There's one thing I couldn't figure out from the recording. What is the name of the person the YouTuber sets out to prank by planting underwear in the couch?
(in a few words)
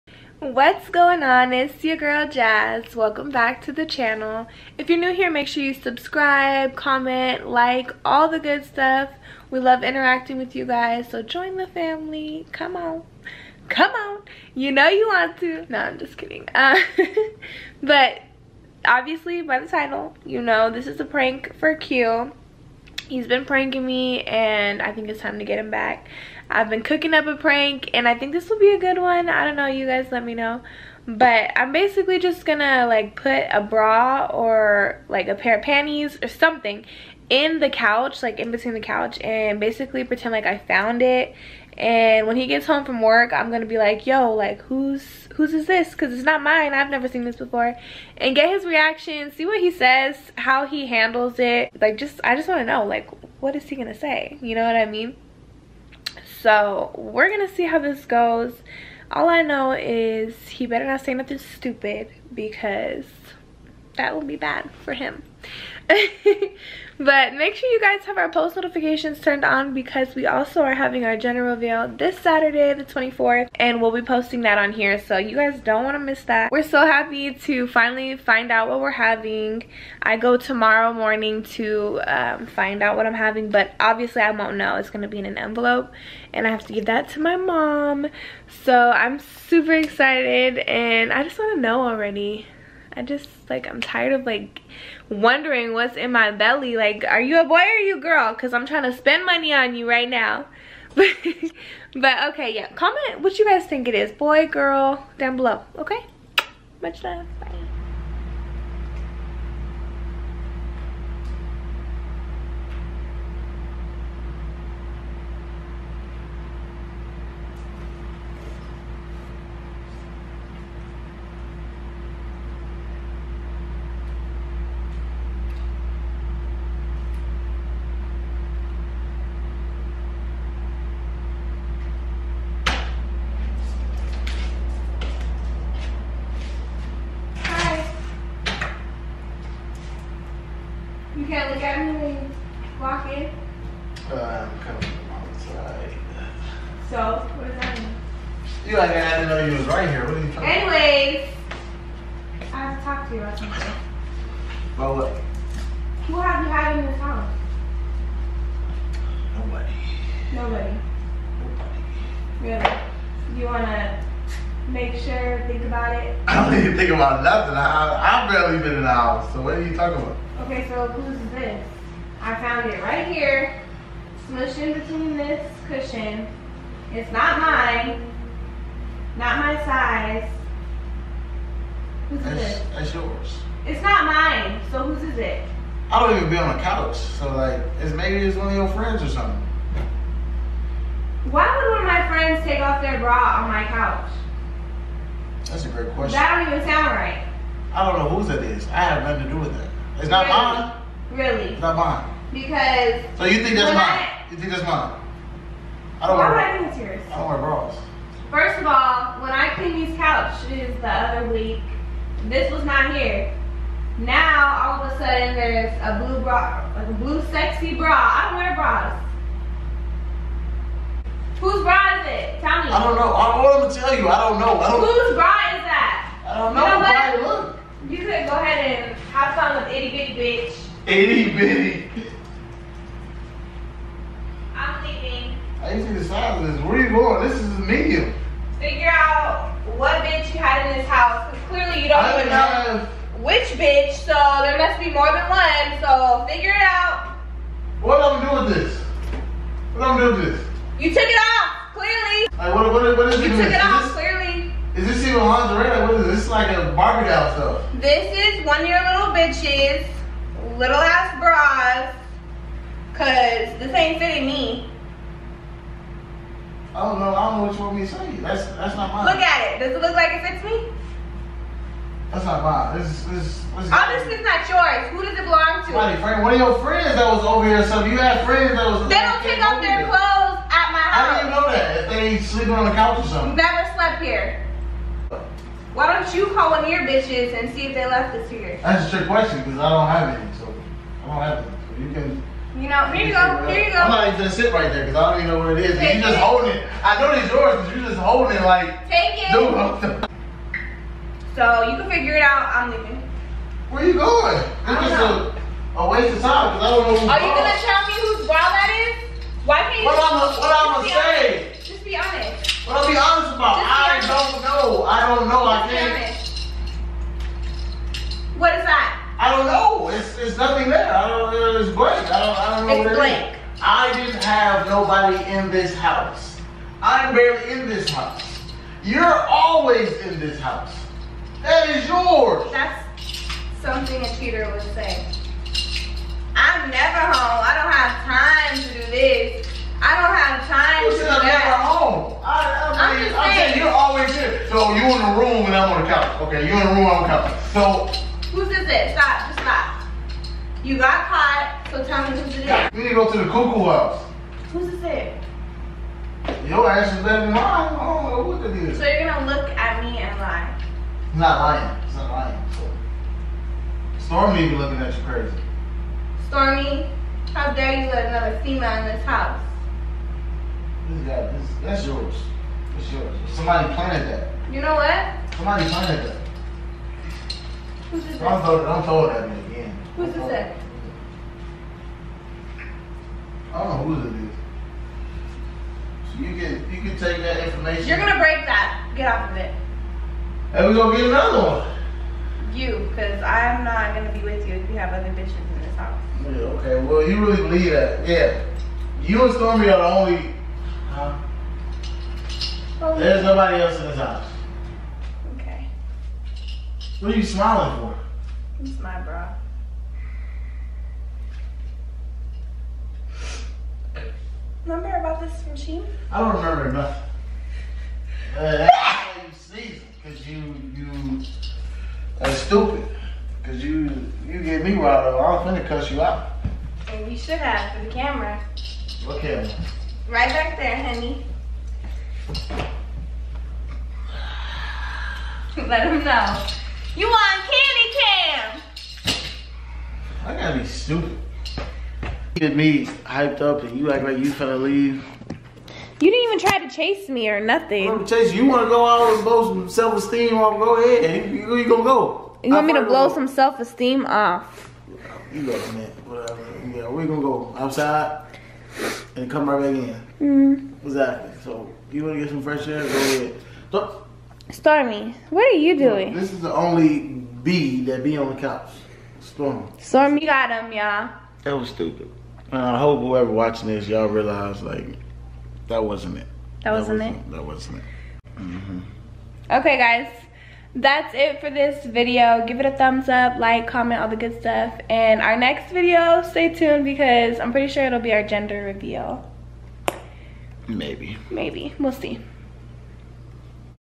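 Q.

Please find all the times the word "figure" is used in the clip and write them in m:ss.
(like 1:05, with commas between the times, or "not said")
3:58, 4:06, 5:01.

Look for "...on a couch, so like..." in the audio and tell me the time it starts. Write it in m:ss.
3:06.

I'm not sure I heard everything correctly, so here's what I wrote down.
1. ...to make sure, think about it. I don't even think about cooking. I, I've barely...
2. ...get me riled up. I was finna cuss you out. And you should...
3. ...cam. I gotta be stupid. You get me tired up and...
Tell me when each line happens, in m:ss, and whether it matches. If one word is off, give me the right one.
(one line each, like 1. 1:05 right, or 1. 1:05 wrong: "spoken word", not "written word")
1. 2:43 wrong: "nothing", not "cooking"
2. 7:04 right
3. 7:17 wrong: "hyped", not "tired".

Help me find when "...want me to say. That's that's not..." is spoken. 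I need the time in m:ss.
4:27.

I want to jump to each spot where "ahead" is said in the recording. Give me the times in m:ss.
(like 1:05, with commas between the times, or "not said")
3:48, 7:30, 7:42.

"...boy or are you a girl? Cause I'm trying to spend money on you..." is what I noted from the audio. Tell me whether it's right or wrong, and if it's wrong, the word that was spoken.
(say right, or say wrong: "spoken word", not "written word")
right.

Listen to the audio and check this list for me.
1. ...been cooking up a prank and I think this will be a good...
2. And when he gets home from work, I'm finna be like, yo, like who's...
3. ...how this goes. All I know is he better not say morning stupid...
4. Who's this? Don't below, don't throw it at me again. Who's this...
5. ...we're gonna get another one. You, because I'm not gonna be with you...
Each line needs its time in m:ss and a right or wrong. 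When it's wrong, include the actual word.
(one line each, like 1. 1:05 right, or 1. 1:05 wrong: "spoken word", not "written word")
1. 0:26 right
2. 0:41 wrong: "gonna", not "finna"
3. 0:57 wrong: "nothing", not "morning"
4. 6:17 wrong: "throw", not "below"
5. 6:30 right.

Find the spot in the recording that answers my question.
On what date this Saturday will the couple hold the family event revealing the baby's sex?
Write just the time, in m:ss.
1:12.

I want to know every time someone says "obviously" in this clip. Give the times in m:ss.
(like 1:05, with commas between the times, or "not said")
0:18, 1:23, 4:33.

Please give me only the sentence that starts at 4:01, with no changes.
Cause clearly you don't I even know have...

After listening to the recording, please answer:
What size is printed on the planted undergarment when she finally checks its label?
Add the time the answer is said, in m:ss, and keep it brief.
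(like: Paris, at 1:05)
medium, at 3:57.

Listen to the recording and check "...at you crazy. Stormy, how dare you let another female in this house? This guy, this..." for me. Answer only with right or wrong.
right.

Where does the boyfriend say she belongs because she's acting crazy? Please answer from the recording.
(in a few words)
the cuckoo house.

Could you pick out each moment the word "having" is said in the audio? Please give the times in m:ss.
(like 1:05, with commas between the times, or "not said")
1:10, 1:18, 1:23.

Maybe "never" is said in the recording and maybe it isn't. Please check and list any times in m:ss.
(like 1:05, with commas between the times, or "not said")
0:46, 4:43, 5:36.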